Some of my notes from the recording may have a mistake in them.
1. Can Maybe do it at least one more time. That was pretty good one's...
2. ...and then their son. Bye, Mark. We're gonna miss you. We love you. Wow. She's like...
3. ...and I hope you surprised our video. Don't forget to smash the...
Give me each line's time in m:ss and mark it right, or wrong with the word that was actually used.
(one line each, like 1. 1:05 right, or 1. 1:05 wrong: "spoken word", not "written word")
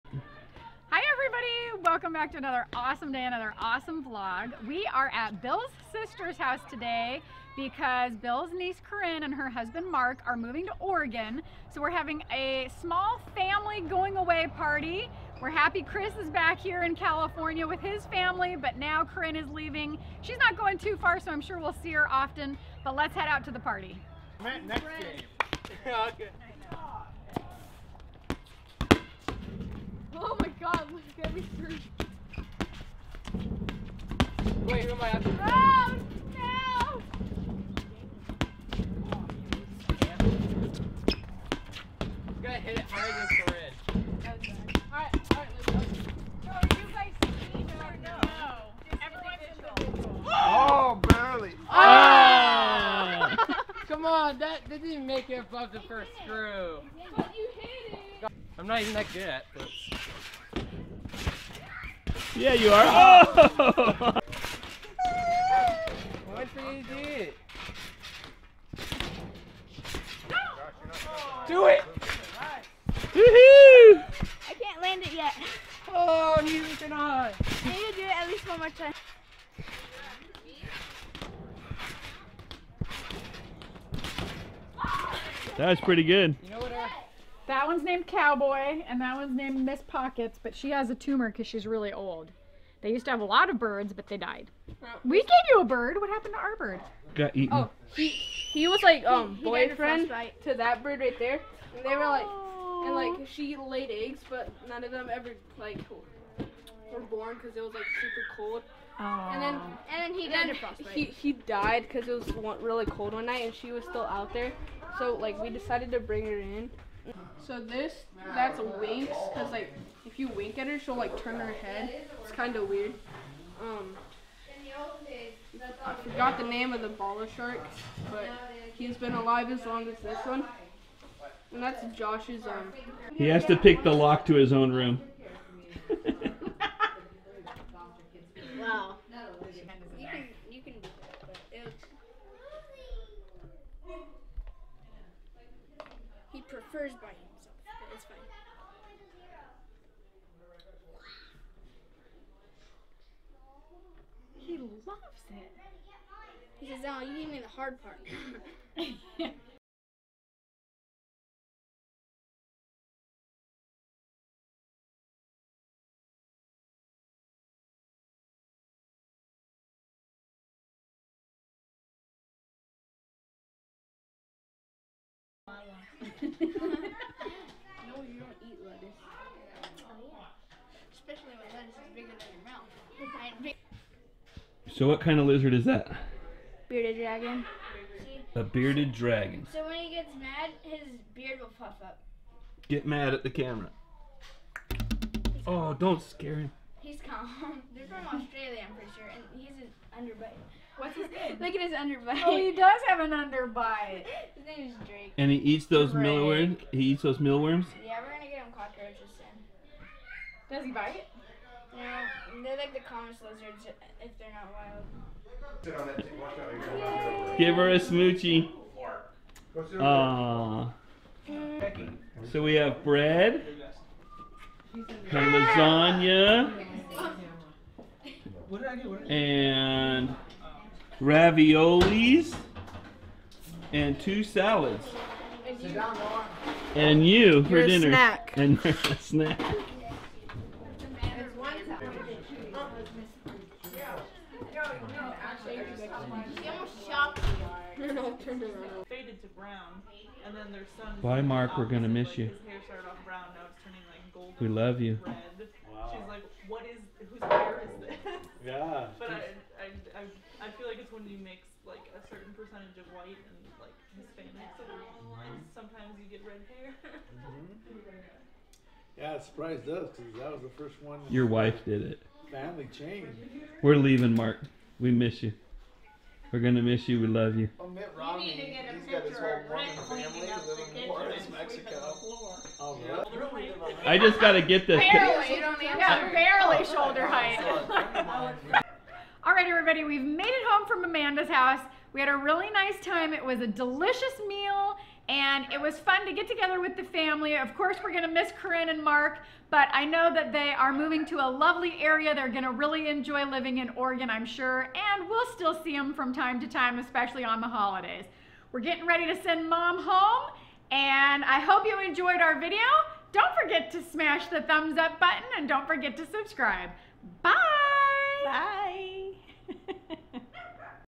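1. 1:17 right
2. 4:10 right
3. 5:10 wrong: "enjoyed", not "surprised".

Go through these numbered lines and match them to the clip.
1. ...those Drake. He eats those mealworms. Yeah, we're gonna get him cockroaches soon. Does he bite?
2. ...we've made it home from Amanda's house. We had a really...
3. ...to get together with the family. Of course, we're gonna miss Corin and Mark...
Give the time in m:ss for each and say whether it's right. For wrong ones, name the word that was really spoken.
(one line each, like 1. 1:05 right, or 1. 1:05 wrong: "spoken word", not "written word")
1. 3:25 right
2. 4:49 right
3. 4:56 right.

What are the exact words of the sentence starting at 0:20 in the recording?
She's not going too far, so I'm sure we'll see her often, but let's head out to the party.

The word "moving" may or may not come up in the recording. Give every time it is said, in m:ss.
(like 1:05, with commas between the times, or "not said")
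0:10, 5:00.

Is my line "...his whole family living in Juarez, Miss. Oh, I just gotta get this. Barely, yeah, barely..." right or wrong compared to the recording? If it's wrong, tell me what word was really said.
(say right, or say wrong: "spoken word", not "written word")
wrong: "Mexico", not "Miss".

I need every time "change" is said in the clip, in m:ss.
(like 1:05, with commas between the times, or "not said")
4:32.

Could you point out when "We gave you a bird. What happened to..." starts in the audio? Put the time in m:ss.
1:35.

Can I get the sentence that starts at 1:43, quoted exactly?
she laid eggs, but none of them ever like were born because it was like super cold.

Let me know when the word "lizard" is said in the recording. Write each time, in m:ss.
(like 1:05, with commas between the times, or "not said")
3:05, 3:33.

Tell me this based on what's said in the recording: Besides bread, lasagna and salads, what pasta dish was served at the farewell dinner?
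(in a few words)
Raviolis.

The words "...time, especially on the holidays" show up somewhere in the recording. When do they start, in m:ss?
5:06.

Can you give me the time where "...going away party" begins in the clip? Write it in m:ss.
0:13.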